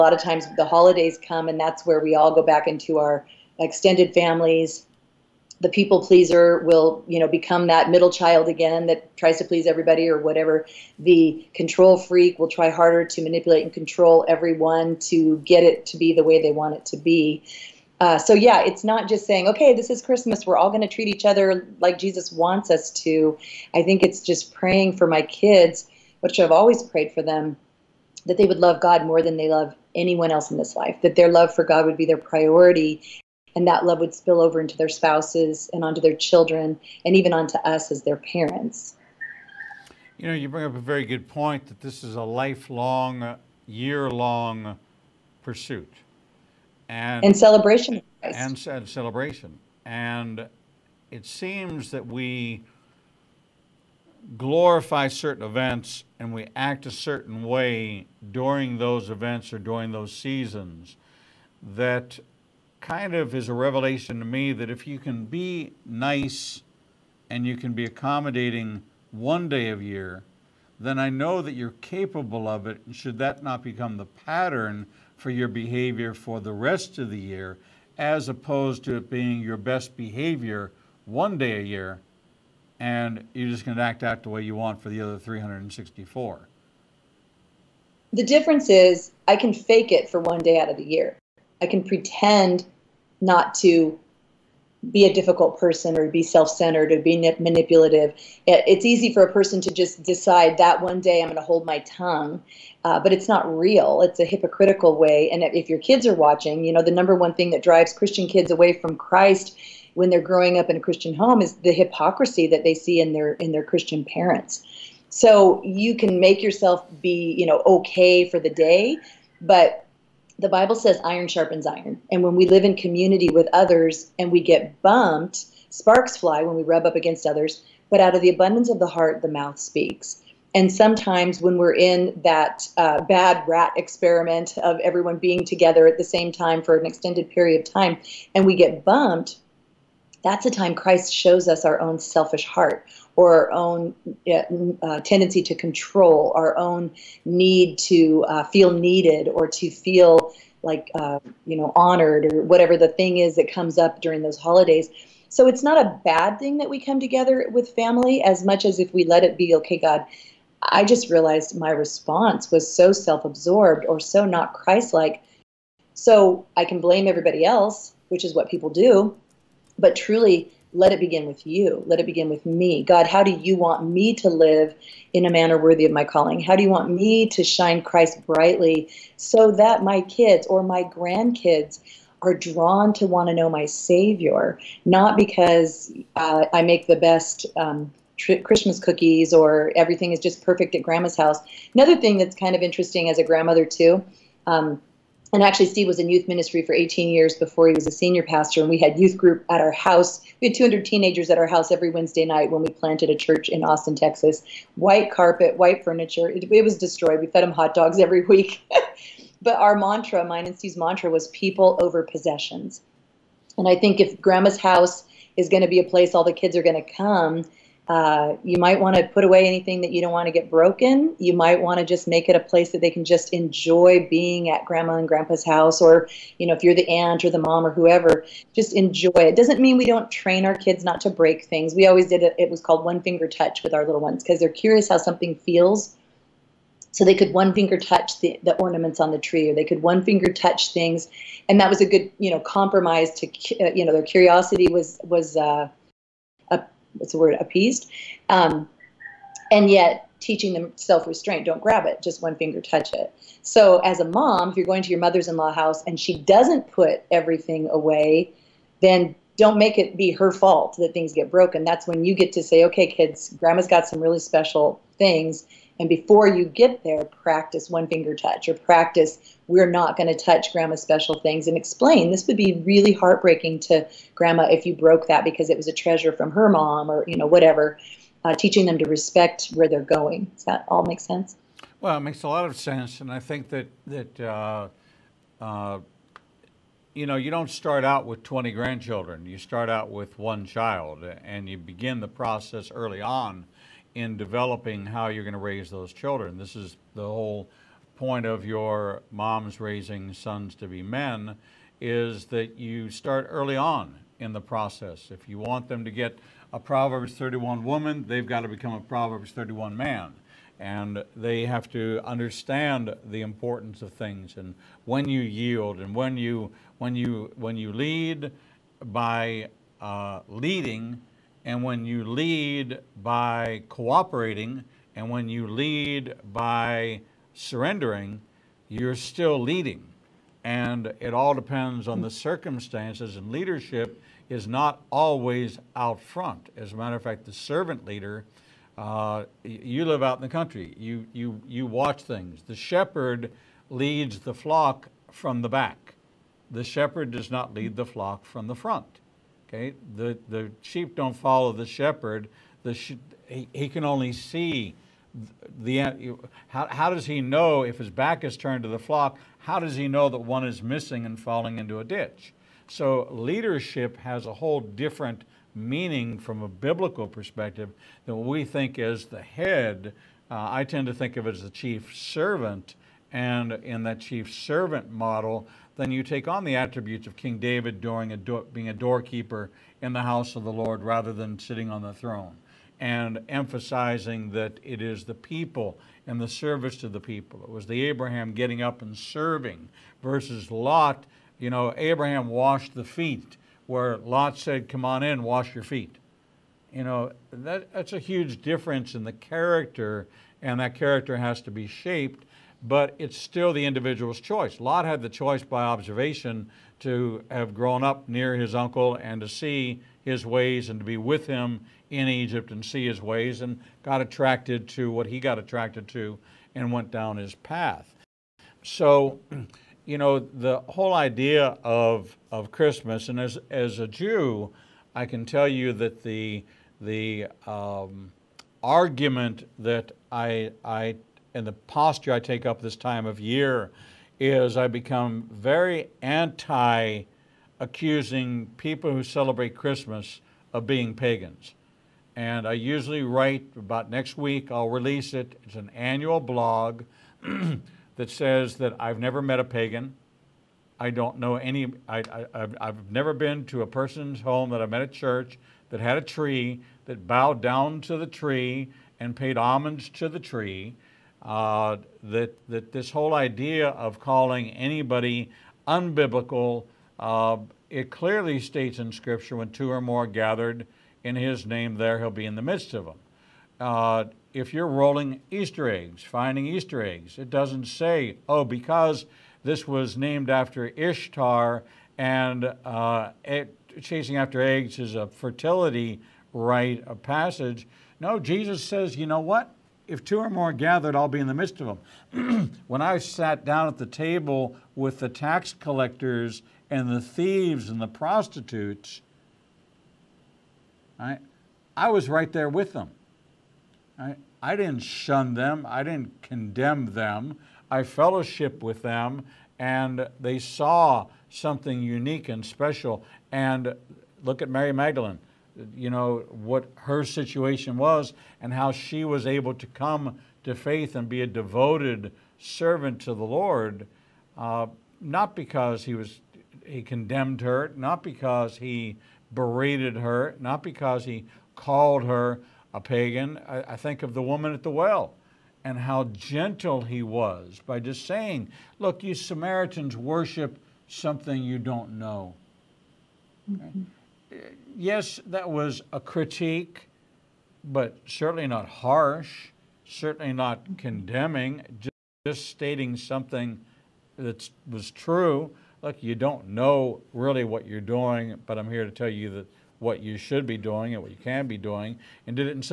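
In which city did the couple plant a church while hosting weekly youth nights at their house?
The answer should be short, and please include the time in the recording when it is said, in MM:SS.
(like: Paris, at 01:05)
Austin, Texas, at 03:23.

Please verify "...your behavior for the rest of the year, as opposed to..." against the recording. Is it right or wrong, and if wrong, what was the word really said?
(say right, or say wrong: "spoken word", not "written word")
right.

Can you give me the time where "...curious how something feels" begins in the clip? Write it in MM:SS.
03:54.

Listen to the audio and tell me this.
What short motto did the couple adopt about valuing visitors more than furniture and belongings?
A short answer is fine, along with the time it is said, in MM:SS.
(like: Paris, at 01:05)
People over possessions, at 03:31.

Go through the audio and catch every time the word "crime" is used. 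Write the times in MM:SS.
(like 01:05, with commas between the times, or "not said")
not said.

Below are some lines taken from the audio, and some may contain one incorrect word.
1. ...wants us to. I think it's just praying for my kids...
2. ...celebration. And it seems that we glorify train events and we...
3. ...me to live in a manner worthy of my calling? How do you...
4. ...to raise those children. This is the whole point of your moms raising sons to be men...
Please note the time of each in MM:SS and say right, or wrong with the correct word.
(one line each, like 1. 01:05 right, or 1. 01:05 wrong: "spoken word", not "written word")
1. 00:22 right
2. 00:48 wrong: "certain", not "train"
3. 02:53 right
4. 04:55 right.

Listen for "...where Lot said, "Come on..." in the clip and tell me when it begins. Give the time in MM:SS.
06:33.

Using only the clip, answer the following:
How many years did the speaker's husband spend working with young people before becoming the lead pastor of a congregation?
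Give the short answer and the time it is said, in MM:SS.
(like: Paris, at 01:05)
18, at 03:16.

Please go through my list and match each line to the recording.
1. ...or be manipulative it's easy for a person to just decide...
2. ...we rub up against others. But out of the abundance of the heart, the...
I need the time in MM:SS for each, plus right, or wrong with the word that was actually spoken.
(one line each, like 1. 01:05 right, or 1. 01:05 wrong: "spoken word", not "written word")
1. 01:36 right
2. 02:06 right.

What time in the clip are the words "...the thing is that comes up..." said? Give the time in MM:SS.
02:32.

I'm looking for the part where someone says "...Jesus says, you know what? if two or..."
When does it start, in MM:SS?
08:08.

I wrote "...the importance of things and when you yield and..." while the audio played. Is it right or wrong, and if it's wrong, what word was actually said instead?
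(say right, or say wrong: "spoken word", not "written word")
right.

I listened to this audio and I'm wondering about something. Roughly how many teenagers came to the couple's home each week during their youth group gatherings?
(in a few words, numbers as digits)
200.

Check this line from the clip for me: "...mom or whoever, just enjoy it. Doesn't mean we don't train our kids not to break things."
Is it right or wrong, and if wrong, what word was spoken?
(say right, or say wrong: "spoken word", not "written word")
right.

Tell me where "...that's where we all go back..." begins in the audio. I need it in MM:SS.
00:01.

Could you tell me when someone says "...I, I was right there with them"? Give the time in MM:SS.
08:20.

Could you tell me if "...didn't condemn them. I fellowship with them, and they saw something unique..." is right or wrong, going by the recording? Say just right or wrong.
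right.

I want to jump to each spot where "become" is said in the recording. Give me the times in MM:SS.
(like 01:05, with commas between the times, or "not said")
00:07, 01:13, 05:08, 07:14.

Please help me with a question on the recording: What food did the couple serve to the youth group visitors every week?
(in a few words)
Hot dogs.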